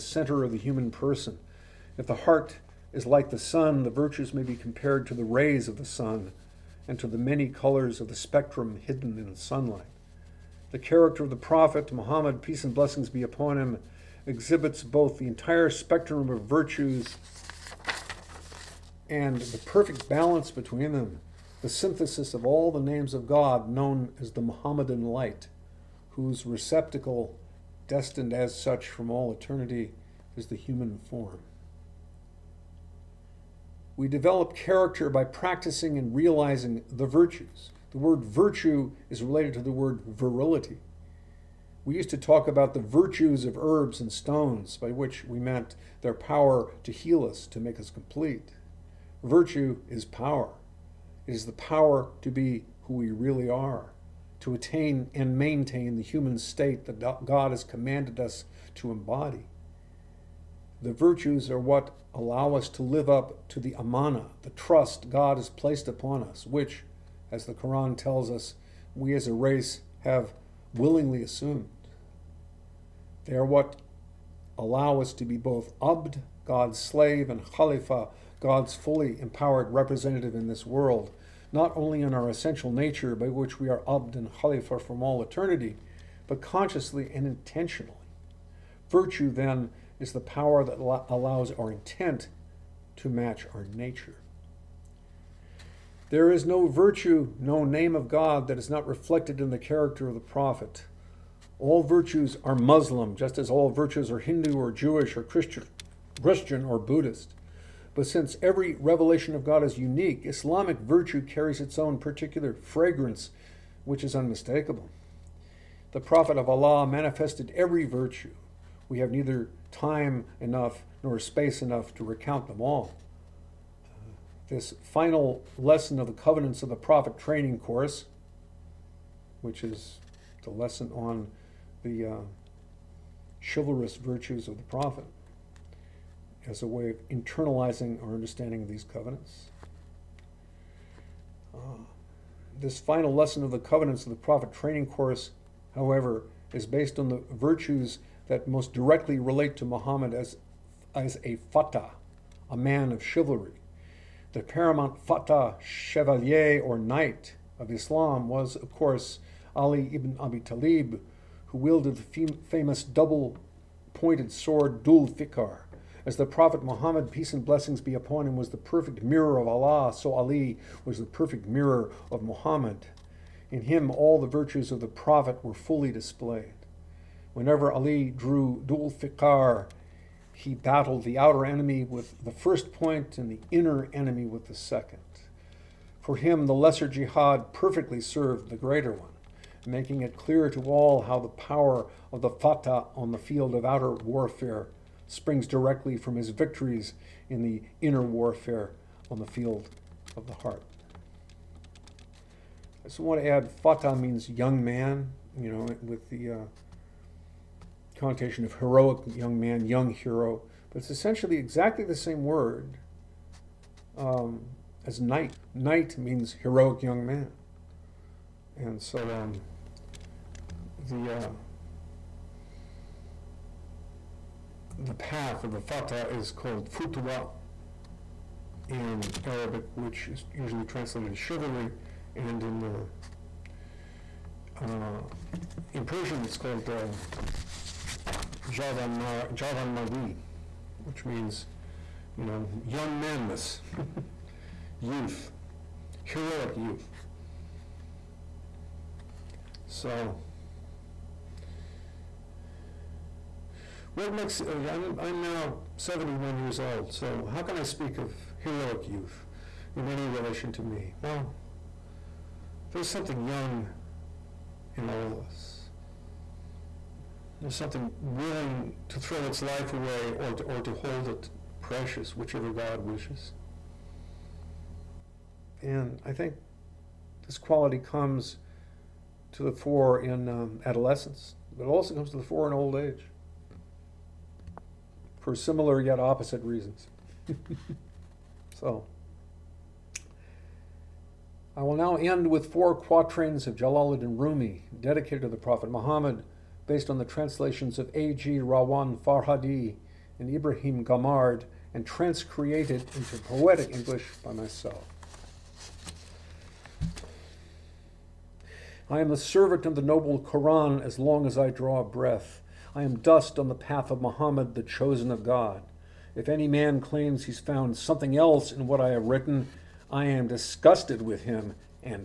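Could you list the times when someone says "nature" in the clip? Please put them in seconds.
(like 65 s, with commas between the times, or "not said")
82 s, 93 s.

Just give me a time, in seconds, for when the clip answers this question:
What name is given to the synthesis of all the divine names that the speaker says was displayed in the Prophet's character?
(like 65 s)
24 s.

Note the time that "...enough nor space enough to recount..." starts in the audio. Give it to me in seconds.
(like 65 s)
120 s.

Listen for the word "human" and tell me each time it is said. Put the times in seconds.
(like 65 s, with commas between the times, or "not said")
0 s, 30 s, 56 s.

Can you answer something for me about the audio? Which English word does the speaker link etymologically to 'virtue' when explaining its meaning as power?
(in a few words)
virility.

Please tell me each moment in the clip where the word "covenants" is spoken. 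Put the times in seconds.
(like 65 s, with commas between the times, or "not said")
126 s, 138 s, 143 s.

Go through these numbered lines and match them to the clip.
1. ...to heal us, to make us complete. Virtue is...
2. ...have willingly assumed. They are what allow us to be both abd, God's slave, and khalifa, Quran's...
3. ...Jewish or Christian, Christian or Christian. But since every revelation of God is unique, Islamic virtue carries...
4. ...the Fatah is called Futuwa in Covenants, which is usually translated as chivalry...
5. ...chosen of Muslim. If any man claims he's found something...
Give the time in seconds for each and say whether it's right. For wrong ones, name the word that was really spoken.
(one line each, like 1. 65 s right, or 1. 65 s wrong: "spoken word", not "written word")
1. 46 s right
2. 70 s wrong: "God", not "Quran"
3. 104 s wrong: "Buddhist", not "Christian"
4. 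225 s wrong: "Arabic", not "Covenants"
5. 314 s wrong: "God", not "Muslim".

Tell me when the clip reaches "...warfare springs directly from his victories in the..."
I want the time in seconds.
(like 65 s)
193 s.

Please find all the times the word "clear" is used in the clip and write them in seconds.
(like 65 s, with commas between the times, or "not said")
190 s.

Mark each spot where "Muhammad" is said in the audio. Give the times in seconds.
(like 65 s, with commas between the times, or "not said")
11 s, 149 s, 166 s, 172 s, 295 s, 314 s.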